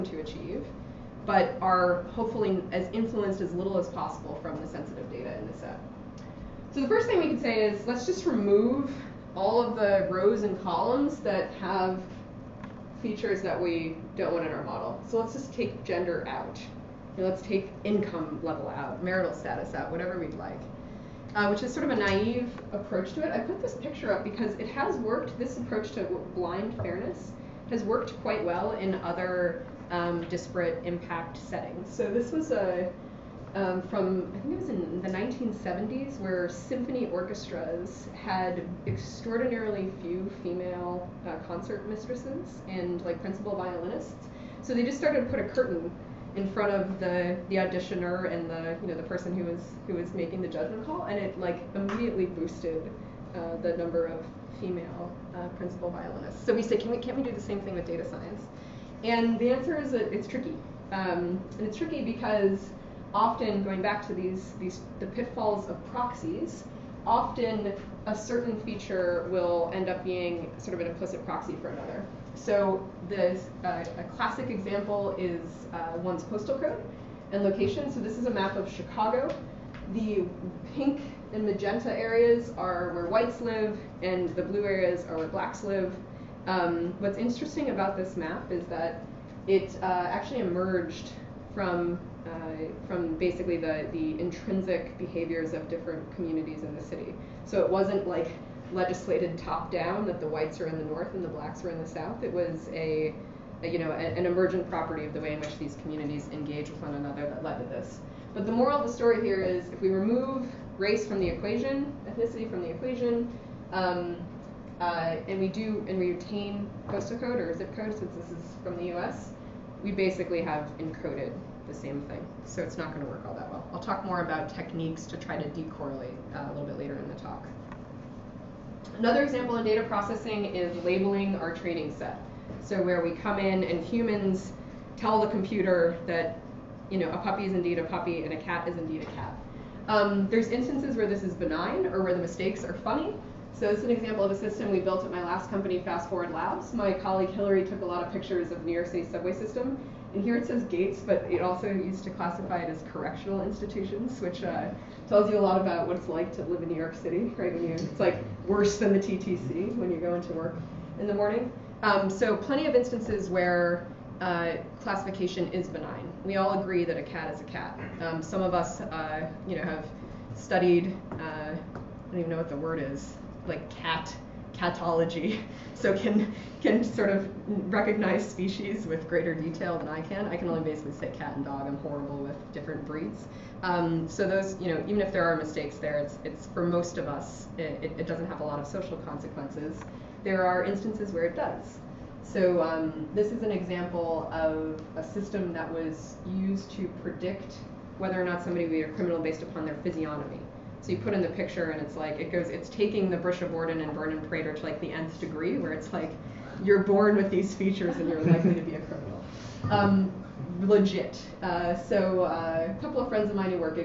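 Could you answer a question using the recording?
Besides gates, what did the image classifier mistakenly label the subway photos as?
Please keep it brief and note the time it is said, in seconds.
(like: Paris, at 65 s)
correctional institutions, at 152 s.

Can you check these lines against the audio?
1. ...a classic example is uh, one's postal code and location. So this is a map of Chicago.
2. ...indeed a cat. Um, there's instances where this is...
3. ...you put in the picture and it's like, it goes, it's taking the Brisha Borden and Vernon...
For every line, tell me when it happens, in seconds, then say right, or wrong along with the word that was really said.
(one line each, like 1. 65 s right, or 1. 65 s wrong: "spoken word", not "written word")
1. 73 s right
2. 138 s right
3. 200 s right.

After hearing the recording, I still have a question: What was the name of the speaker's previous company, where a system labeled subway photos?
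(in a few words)
Fast Forward Labs.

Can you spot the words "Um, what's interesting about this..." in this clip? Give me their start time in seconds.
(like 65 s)
86 s.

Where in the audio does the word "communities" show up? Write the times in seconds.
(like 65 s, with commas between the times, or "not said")
96 s, 105 s.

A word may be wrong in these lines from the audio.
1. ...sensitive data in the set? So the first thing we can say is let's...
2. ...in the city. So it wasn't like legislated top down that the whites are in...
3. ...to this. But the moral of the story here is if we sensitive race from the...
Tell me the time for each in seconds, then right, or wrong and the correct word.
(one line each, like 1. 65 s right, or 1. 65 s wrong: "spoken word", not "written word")
1. 4 s right
2. 96 s right
3. 107 s wrong: "remove", not "sensitive".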